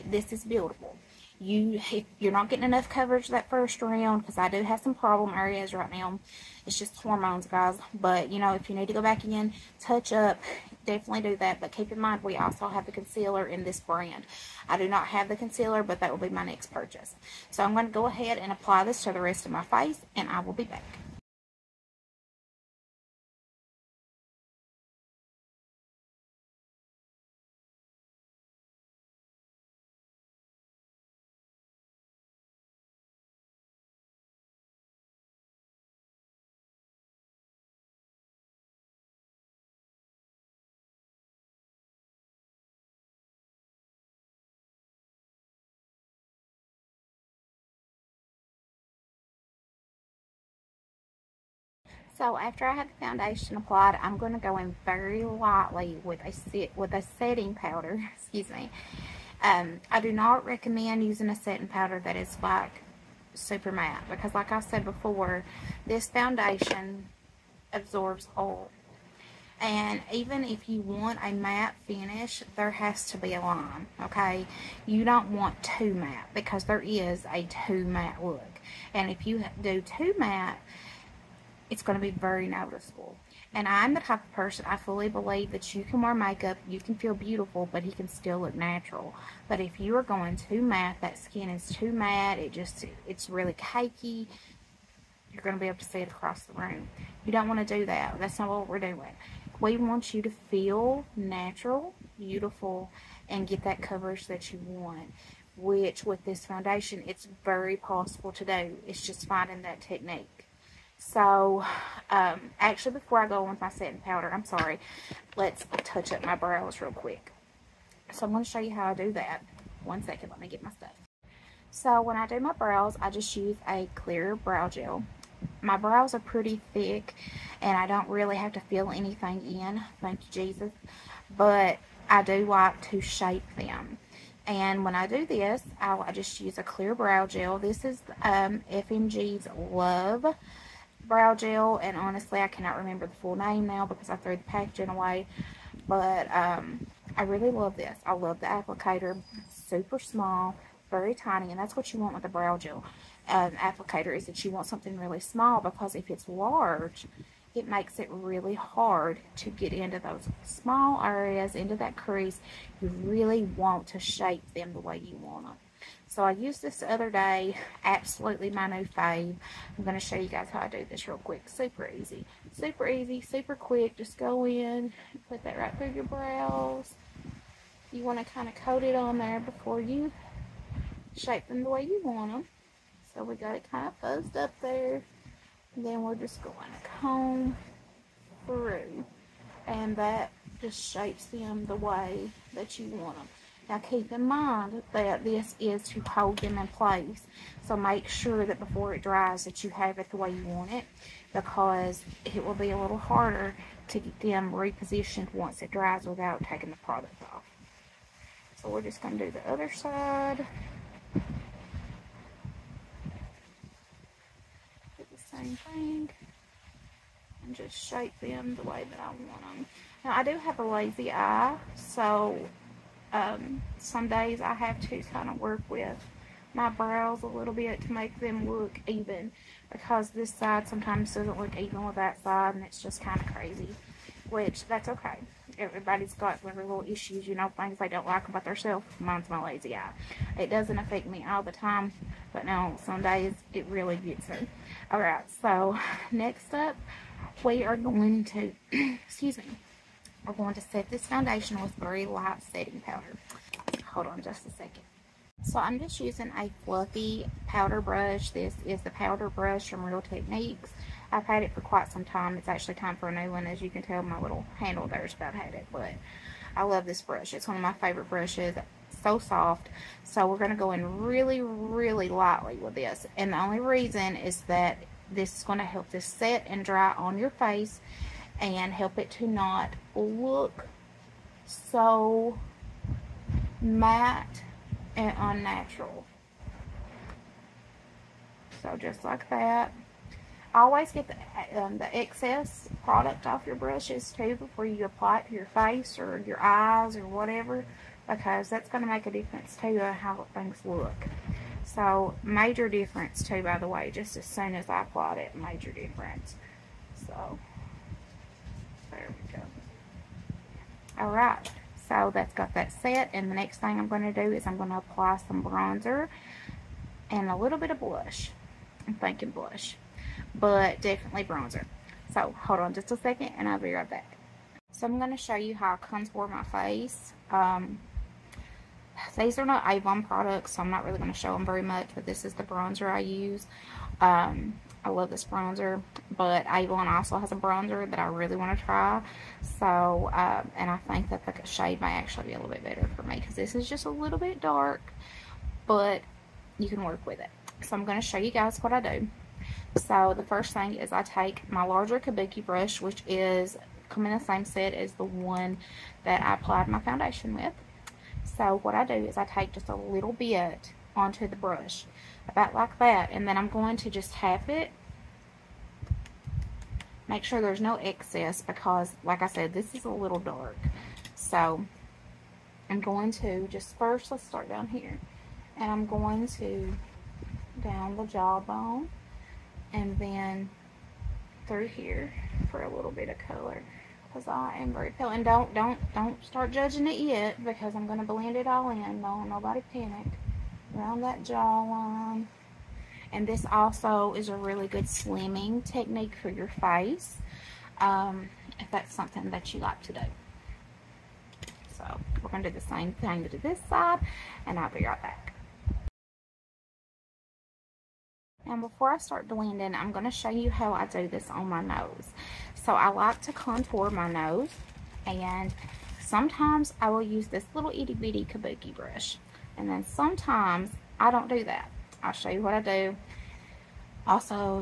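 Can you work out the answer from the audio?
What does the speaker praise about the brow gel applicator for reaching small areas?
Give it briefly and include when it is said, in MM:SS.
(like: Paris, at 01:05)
Super small, at 02:29.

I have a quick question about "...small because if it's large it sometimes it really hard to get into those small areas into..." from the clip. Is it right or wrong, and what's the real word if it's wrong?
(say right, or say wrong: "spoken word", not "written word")
wrong: "makes", not "sometimes".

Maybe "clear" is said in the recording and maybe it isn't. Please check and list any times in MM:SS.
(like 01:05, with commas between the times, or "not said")
02:03, 02:16.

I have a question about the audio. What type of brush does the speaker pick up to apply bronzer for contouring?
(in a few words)
Larger kabuki brush.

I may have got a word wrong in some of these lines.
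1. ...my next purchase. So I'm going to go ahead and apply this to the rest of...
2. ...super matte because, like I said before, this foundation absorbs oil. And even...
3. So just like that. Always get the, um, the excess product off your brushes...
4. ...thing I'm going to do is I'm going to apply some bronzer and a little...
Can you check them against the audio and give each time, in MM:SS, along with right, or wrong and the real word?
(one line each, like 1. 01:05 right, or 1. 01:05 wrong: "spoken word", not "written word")
1. 00:16 right
2. 01:03 right
3. 04:48 right
4. 05:13 right.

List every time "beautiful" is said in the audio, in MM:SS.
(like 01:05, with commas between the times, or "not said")
01:27, 01:42.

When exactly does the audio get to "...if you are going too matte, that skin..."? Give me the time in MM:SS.
01:29.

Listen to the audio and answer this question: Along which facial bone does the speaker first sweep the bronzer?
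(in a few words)
Jawbone.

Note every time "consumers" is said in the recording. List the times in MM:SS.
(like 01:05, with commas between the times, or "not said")
not said.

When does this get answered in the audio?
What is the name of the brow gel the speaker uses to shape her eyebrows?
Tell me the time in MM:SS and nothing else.
02:18.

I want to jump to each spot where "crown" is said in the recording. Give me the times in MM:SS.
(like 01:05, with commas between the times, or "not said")
not said.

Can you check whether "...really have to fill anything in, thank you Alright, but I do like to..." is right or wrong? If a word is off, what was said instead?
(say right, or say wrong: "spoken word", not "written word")
wrong: "Jesus", not "Alright".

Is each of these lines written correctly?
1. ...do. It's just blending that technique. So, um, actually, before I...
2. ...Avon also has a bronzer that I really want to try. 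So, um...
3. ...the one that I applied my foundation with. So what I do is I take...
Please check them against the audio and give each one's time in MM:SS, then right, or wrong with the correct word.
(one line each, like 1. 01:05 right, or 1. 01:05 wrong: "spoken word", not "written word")
1. 01:48 wrong: "finding", not "blending"
2. 05:36 right
3. 05:54 right.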